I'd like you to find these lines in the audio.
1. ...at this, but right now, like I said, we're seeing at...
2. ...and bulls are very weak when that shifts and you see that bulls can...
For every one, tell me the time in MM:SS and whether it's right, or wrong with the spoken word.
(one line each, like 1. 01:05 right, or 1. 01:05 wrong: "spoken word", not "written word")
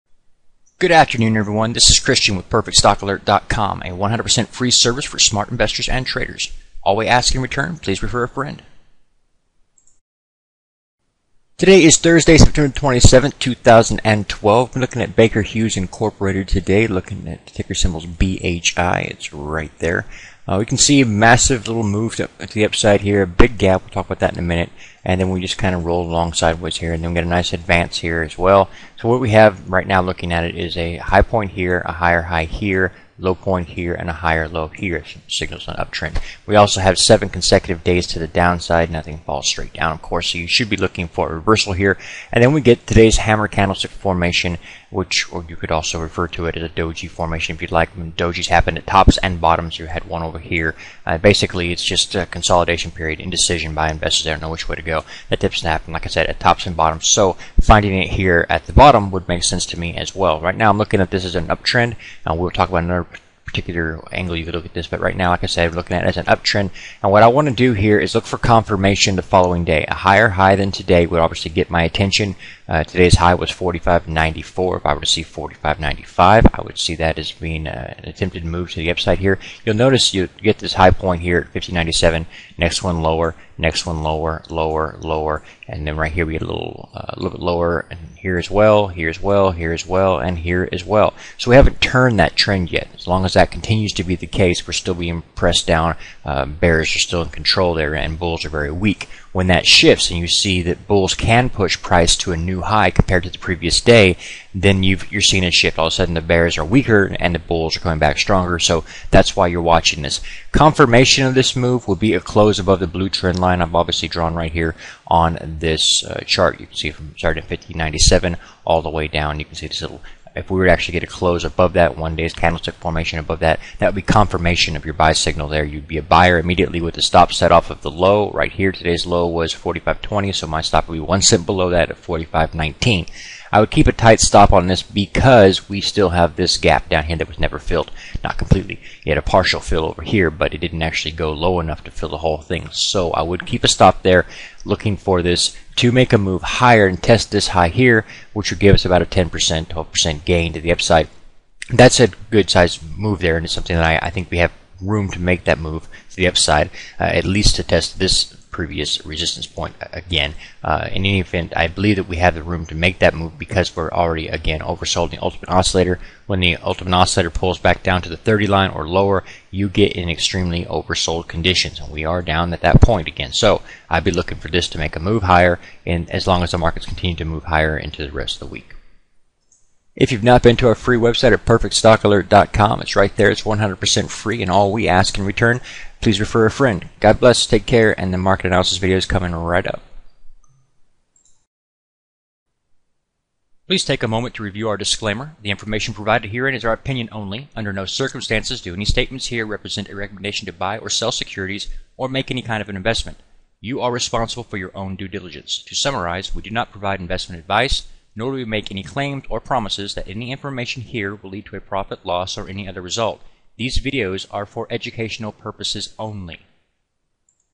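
1. 01:04 wrong: "looking", not "seeing"
2. 01:37 right.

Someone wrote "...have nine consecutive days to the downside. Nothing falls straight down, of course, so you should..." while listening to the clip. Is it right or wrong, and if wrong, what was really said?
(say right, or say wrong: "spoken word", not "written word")
wrong: "seven", not "nine".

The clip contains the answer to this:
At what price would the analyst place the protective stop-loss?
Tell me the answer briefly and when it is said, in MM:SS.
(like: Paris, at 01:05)
45.19, at 02:12.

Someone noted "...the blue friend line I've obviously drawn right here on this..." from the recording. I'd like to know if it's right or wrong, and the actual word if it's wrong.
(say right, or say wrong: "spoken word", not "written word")
wrong: "trend", not "friend".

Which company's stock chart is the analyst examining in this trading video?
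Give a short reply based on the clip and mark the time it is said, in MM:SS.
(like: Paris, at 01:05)
Baker Hughes Incorporated, at 00:15.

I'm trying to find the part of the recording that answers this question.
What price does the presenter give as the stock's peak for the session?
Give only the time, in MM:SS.
01:13.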